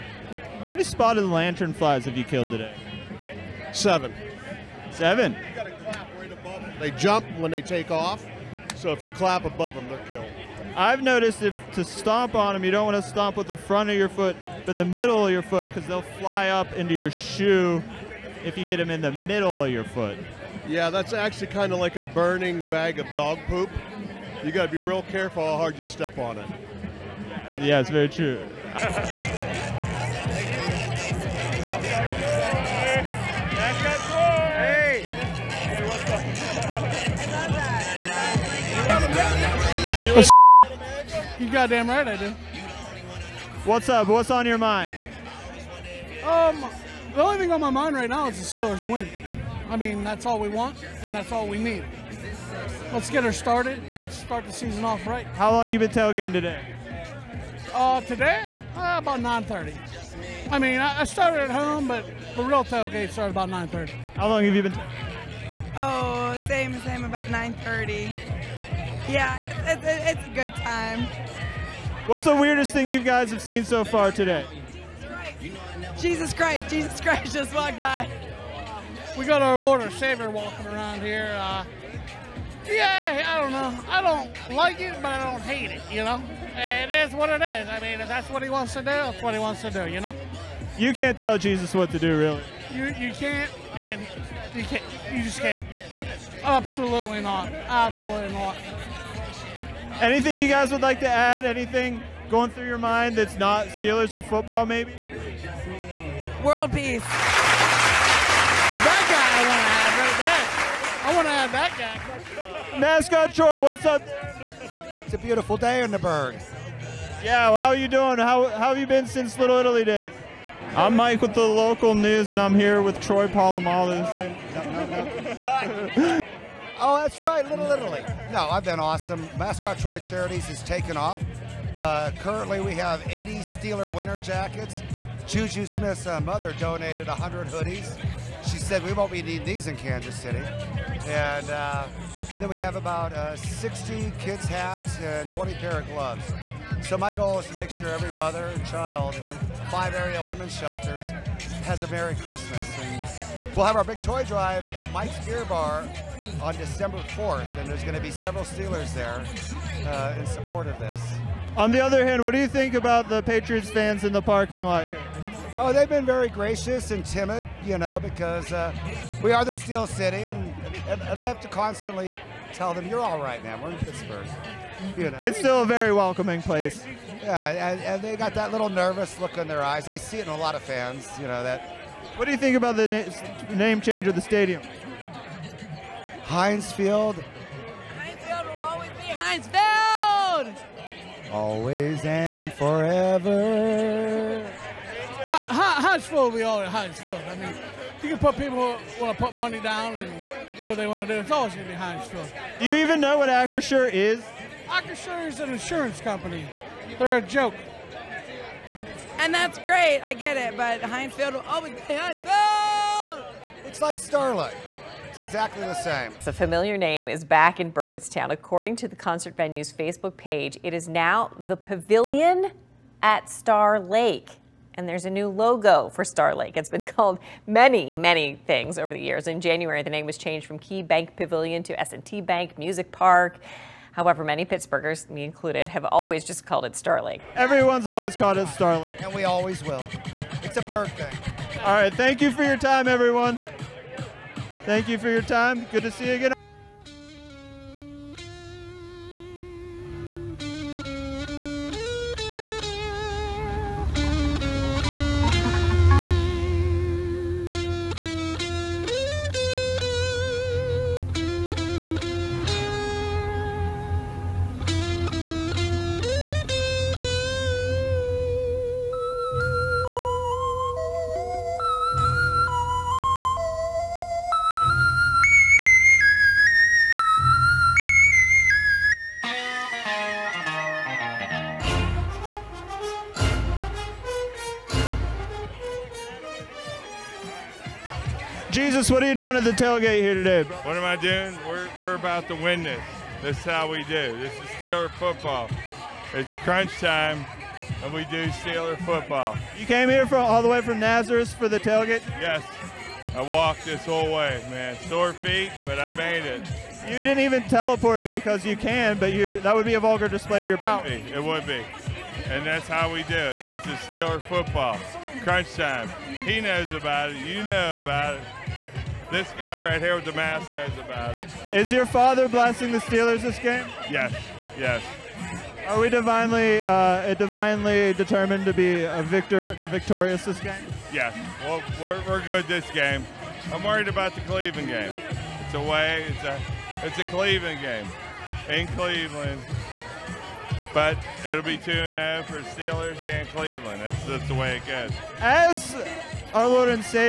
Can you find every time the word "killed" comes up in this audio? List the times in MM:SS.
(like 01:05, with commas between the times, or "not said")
00:02, 00:10.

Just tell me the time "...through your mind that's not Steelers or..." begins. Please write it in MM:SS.
01:42.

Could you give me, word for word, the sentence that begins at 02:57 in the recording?
Yeah, and, and, they got that little nervous look in their eyes.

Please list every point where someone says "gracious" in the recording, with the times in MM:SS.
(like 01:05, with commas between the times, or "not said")
02:46.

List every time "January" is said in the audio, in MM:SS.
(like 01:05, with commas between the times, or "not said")
03:49.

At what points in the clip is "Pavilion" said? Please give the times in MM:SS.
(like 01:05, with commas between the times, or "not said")
03:41, 03:51.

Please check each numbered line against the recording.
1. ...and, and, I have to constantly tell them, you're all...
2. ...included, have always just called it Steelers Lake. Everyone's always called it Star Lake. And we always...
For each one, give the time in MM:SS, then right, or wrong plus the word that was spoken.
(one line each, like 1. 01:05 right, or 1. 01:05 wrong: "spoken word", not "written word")
1. 02:50 right
2. 03:55 wrong: "Star", not "Steelers".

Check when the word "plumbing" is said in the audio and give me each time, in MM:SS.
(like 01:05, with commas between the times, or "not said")
not said.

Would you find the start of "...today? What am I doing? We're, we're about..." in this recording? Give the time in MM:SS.
04:50.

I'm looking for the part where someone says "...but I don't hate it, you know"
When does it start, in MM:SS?
01:25.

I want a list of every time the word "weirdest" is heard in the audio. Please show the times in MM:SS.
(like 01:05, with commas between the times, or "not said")
01:12.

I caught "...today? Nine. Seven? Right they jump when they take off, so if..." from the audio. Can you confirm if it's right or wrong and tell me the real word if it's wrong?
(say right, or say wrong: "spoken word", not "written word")
wrong: "Seven", not "Nine".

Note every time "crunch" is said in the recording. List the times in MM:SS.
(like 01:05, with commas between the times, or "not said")
04:56, 05:15.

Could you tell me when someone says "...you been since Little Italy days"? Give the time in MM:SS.
01:58.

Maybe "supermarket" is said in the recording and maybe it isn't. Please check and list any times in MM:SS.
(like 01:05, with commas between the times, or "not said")
not said.